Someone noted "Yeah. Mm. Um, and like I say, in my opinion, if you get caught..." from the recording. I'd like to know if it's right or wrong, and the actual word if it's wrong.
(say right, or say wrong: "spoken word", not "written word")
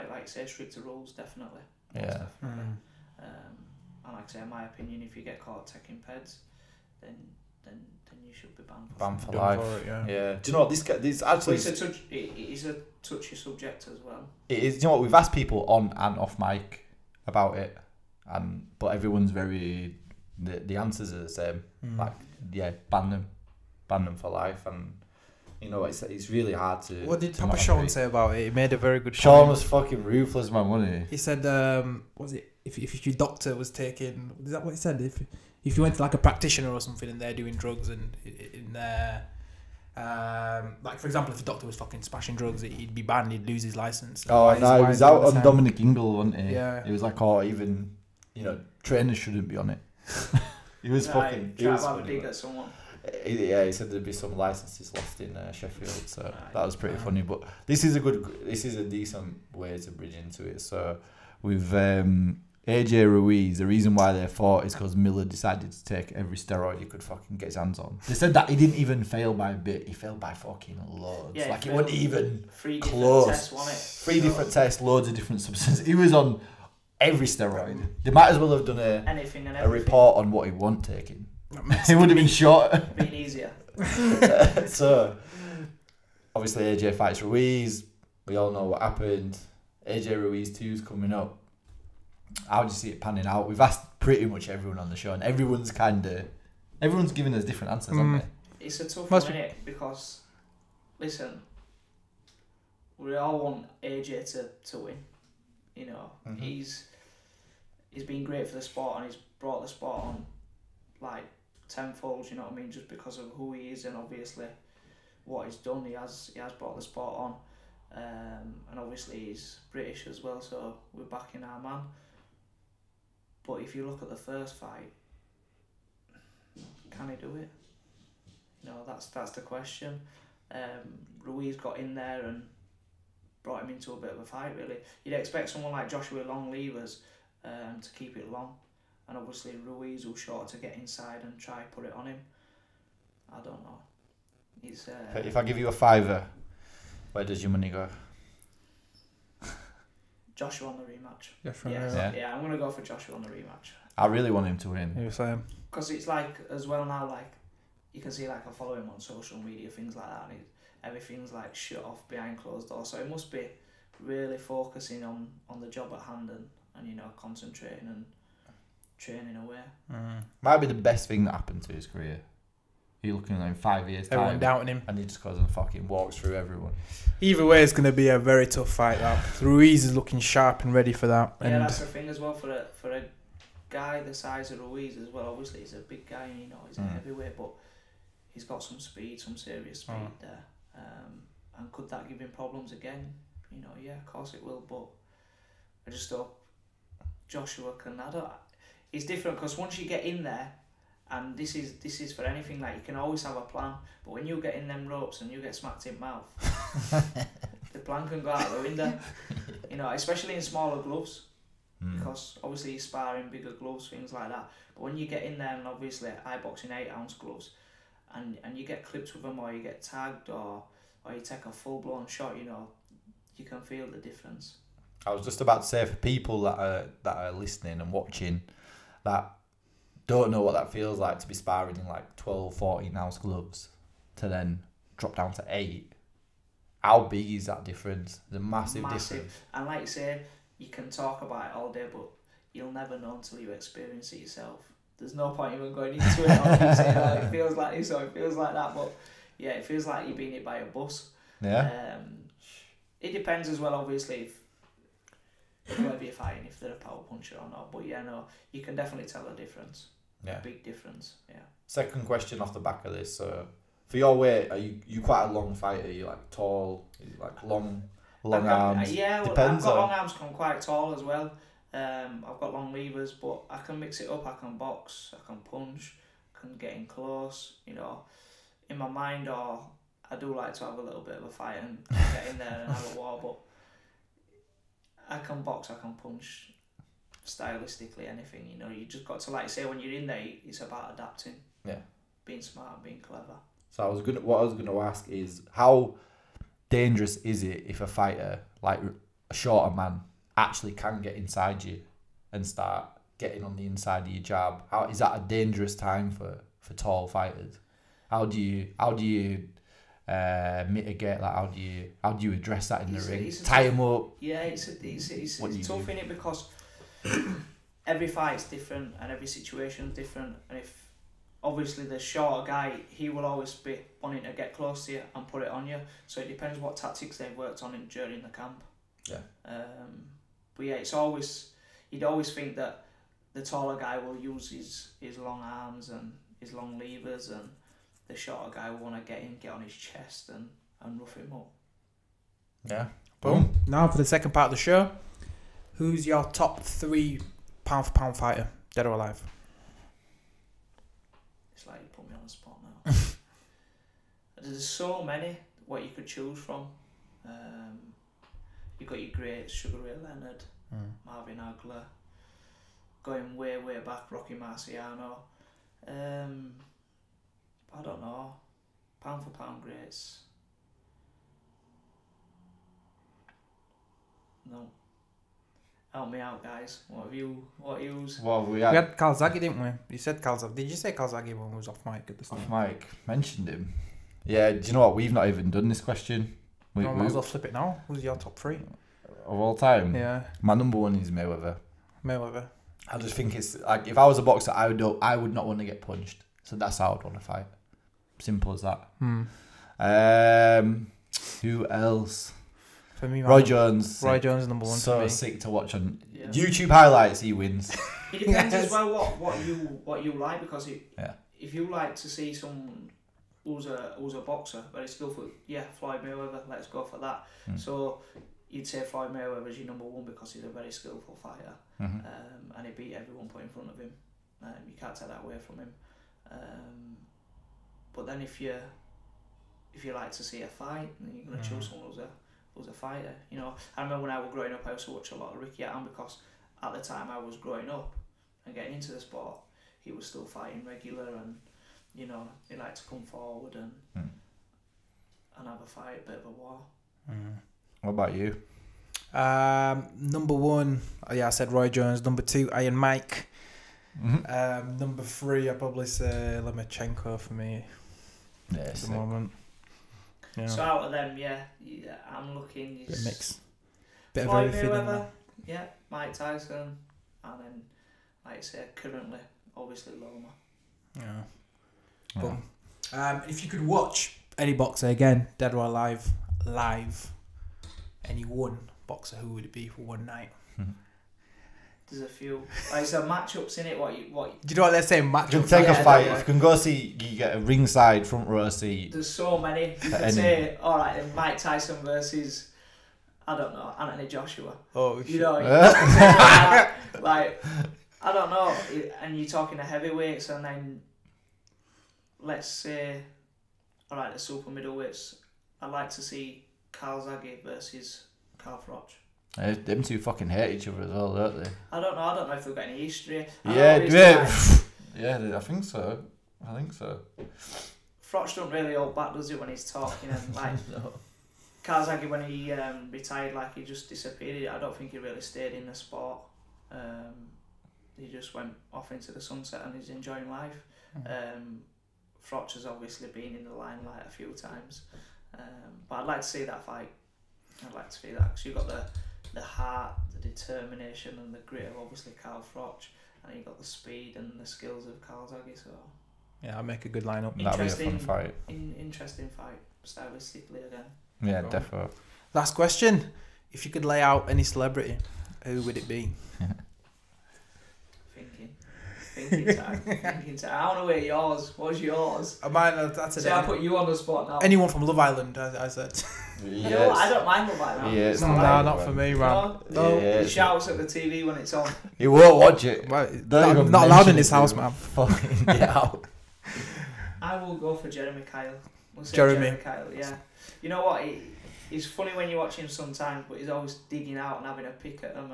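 right.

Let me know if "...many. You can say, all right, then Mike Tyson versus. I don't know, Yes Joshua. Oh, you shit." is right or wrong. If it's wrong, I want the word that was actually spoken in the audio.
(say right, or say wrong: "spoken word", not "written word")
wrong: "Anthony", not "Yes".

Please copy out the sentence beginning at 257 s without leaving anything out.
But yeah, no, you can definitely tell the difference.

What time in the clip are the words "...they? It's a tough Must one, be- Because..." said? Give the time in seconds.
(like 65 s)
98 s.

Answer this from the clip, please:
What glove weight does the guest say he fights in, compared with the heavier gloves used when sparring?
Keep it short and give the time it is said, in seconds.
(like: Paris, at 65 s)
8 ounce, at 216 s.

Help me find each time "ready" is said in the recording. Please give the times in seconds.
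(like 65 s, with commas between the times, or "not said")
180 s.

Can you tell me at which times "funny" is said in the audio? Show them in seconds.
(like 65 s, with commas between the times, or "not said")
51 s, 56 s, 581 s.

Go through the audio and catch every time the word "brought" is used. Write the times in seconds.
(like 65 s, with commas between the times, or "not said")
109 s, 116 s, 133 s.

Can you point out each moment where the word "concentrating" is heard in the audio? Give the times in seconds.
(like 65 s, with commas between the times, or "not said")
167 s.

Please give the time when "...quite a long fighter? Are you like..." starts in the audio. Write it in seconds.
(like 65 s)
265 s.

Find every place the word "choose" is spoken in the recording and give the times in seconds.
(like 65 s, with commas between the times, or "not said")
356 s, 431 s.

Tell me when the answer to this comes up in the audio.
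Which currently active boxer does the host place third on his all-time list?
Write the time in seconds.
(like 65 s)
456 s.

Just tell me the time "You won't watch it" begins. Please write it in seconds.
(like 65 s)
571 s.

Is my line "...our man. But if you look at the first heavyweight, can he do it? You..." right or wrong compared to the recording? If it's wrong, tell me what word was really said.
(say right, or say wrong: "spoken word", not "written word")
wrong: "fight", not "heavyweight".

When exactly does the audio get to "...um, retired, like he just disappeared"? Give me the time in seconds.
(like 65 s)
522 s.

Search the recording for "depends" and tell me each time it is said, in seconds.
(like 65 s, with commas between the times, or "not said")
253 s, 326 s, 408 s.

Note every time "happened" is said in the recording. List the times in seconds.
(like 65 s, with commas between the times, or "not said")
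88 s, 171 s.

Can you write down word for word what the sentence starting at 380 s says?
Did you say Calzaghe when we was off mic at the start?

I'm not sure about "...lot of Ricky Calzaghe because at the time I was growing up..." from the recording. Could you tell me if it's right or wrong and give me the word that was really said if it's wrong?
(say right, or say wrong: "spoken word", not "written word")
wrong: "Hatton", not "Calzaghe".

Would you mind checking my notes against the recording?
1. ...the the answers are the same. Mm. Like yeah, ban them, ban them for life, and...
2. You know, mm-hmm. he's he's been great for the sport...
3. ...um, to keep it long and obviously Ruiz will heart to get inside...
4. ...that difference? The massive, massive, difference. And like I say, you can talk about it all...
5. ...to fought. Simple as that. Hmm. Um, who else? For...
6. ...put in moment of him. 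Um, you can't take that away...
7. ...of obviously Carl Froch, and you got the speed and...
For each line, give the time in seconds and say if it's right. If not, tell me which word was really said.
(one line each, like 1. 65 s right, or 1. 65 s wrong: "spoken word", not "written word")
1. 20 s right
2. 105 s right
3. 137 s wrong: "short", not "heart"
4. 237 s right
5. 397 s wrong: "fight", not "fought"
6. 423 s wrong: "front", not "moment"
7. 541 s right.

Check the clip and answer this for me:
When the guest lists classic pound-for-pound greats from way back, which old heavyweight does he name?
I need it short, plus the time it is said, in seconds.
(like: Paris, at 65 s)
Rocky Marciano, at 364 s.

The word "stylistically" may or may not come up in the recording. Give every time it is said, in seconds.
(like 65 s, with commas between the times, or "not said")
287 s, 549 s.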